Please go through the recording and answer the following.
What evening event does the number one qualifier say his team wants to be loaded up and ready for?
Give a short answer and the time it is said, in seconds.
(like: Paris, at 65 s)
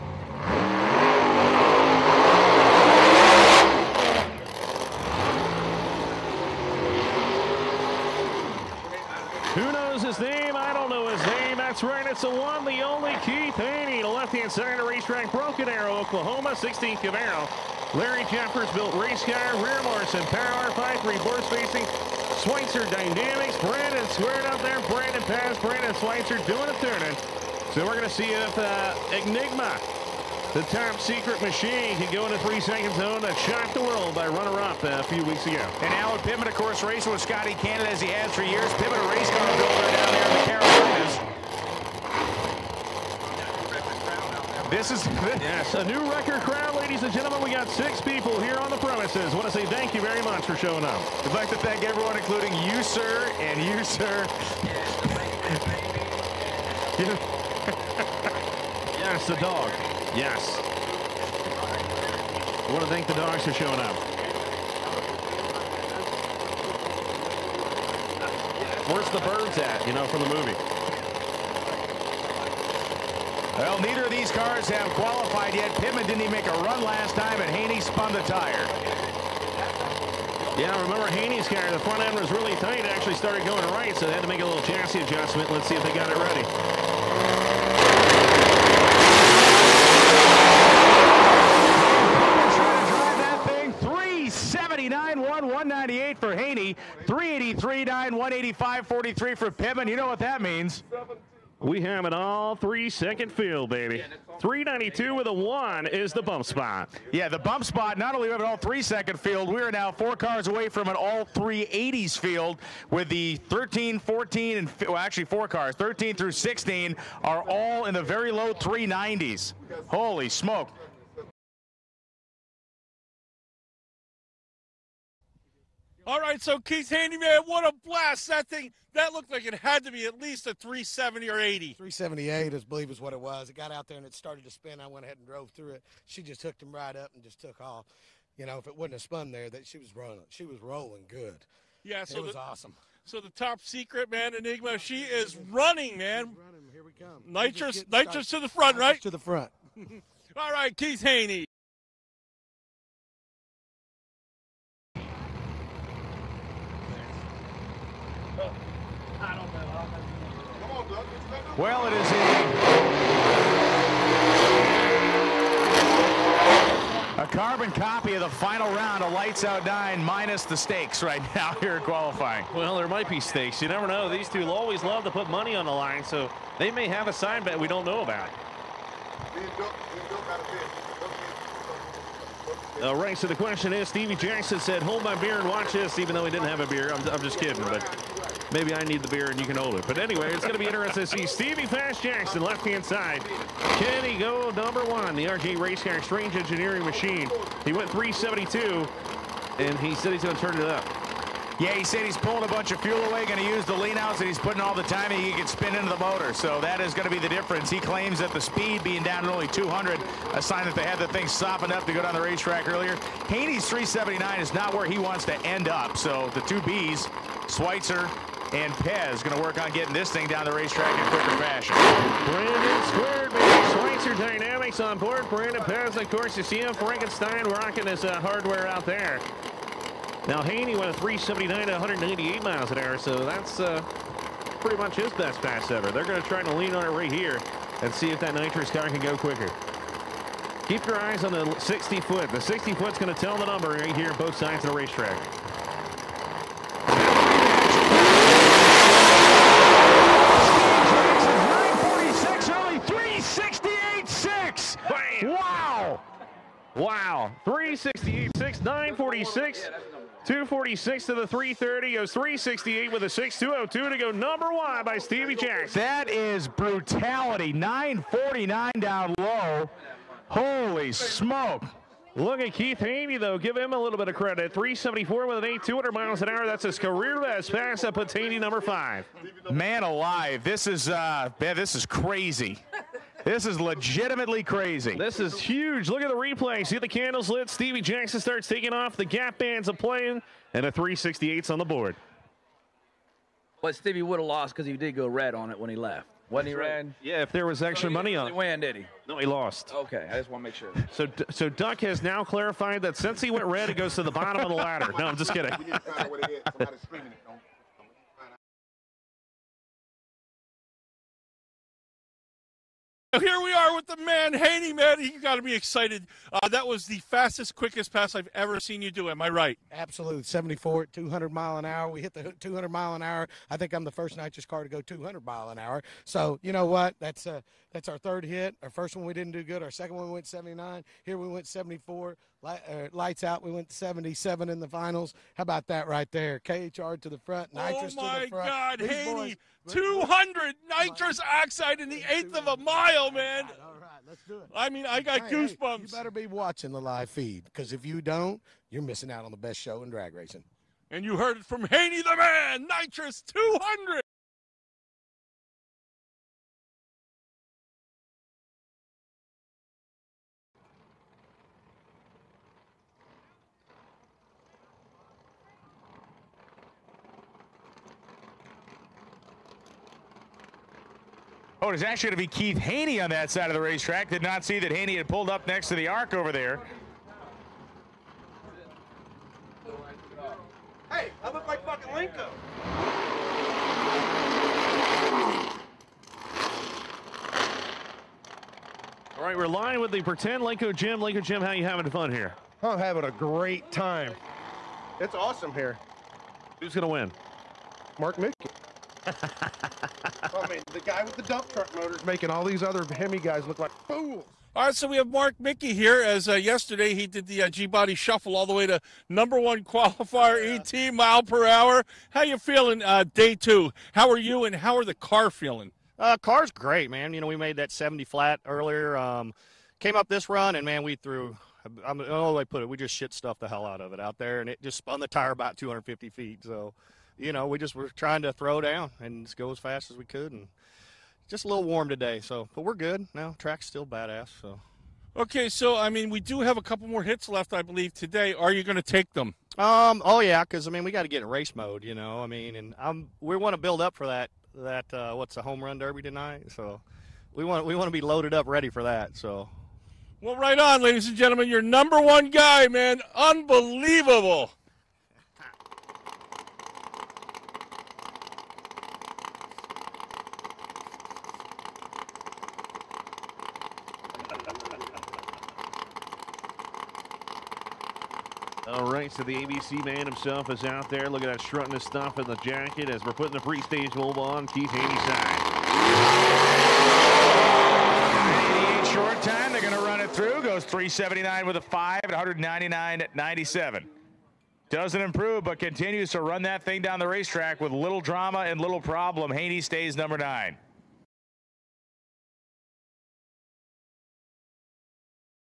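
home run derby, at 445 s.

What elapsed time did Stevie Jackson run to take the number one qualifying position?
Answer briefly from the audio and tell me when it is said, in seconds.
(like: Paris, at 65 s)
3.686, at 262 s.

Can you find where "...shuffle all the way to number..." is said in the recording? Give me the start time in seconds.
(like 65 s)
407 s.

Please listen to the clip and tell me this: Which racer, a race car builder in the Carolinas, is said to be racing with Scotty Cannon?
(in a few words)
Alan Pittman.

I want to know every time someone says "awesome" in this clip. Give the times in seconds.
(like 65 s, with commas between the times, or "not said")
142 s, 395 s.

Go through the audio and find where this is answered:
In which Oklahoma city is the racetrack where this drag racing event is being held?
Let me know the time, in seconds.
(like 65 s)
15 s.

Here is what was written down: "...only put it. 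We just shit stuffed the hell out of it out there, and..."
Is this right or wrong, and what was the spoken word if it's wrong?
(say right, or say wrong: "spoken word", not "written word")
right.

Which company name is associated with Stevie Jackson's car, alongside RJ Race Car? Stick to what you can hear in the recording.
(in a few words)
Strange Engineering.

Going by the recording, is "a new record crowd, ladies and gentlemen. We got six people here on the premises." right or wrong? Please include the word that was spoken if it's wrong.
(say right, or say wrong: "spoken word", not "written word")
right.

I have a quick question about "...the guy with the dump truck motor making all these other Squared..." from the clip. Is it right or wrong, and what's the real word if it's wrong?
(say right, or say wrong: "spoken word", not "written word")
wrong: "Hemi", not "Squared".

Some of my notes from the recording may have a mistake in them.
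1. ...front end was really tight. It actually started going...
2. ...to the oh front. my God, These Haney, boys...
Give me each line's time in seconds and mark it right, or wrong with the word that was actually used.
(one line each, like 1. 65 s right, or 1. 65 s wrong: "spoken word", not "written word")
1. 81 s right
2. 338 s right.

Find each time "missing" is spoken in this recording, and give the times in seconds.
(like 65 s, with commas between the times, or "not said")
348 s.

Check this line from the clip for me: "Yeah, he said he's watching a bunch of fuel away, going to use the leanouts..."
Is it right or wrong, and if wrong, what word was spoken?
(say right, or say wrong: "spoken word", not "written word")
wrong: "pulling", not "watching".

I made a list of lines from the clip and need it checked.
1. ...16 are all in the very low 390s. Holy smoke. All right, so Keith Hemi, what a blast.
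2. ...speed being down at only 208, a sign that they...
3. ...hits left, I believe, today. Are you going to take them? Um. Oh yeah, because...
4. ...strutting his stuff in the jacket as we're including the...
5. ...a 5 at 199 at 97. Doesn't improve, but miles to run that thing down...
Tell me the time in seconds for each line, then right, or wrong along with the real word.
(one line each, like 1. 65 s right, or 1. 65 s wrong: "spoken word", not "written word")
1. 116 s wrong: "Handyman", not "Hemi"
2. 208 s wrong: "200", not "208"
3. 437 s right
4. 471 s wrong: "putting", not "including"
5. 481 s wrong: "continues", not "miles".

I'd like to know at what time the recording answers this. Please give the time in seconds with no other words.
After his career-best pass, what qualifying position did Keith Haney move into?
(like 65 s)
278 s.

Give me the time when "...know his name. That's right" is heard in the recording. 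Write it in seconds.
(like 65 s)
10 s.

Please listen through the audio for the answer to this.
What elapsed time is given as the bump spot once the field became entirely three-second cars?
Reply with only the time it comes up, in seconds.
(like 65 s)
104 s.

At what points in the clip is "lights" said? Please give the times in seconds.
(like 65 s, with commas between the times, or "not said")
169 s, 332 s.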